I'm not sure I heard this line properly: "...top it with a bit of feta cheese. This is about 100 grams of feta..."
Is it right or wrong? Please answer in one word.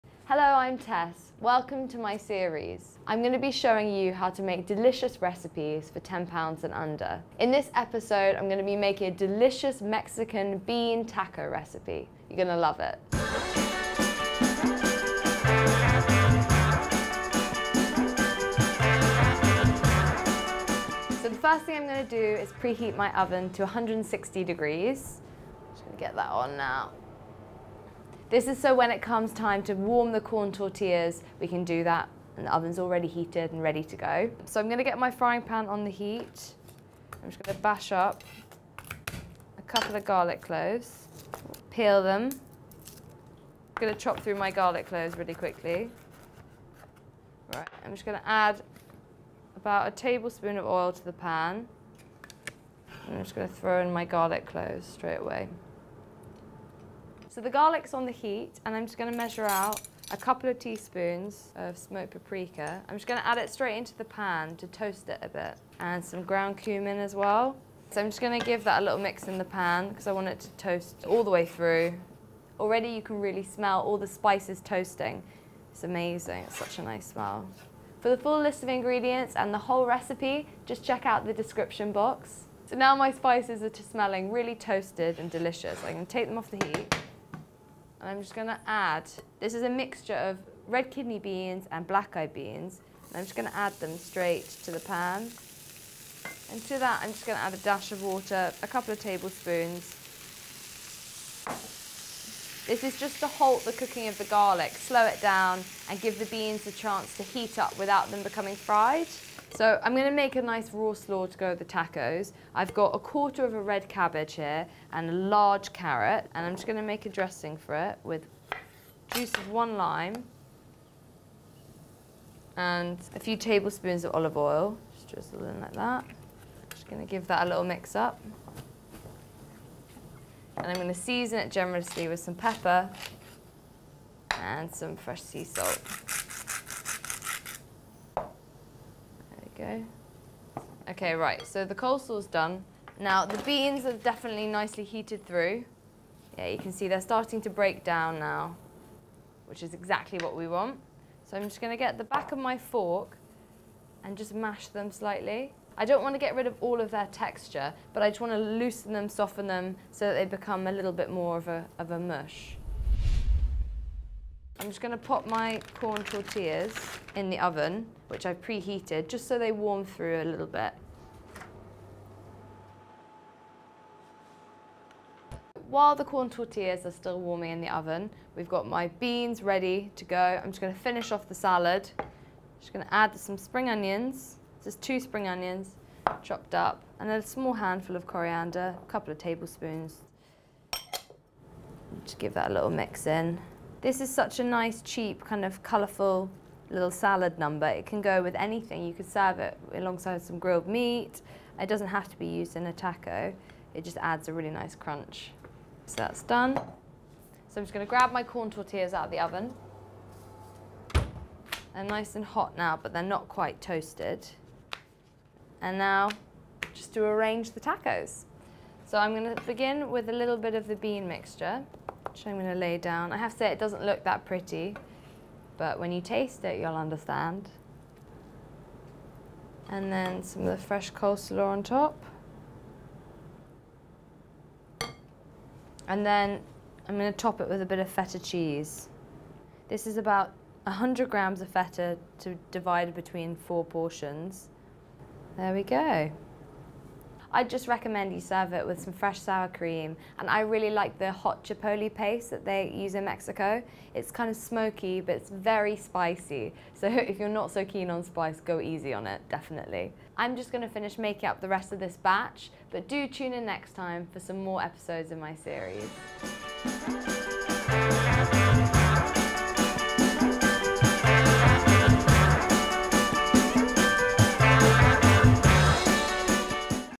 right.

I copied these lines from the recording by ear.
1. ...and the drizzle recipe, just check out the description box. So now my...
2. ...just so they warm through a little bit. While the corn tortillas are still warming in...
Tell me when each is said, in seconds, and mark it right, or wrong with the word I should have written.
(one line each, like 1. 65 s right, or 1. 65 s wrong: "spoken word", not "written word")
1. 79 s wrong: "whole", not "drizzle"
2. 169 s right.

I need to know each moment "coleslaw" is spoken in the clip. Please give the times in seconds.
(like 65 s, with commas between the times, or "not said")
141 s, 230 s.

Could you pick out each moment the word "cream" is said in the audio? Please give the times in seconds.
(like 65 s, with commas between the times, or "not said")
249 s.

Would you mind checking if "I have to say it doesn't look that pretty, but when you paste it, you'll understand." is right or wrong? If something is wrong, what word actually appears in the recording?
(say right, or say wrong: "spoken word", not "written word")
wrong: "taste", not "paste".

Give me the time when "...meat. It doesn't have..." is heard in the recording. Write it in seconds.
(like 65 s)
200 s.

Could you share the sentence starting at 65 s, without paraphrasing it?
And some ground cumin as well.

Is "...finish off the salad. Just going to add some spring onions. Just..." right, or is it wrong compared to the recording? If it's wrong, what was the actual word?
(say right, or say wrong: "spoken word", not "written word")
right.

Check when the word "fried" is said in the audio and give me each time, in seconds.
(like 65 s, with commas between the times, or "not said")
108 s.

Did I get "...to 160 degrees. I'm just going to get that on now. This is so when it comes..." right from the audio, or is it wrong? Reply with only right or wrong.
right.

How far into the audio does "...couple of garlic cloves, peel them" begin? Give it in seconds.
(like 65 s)
39 s.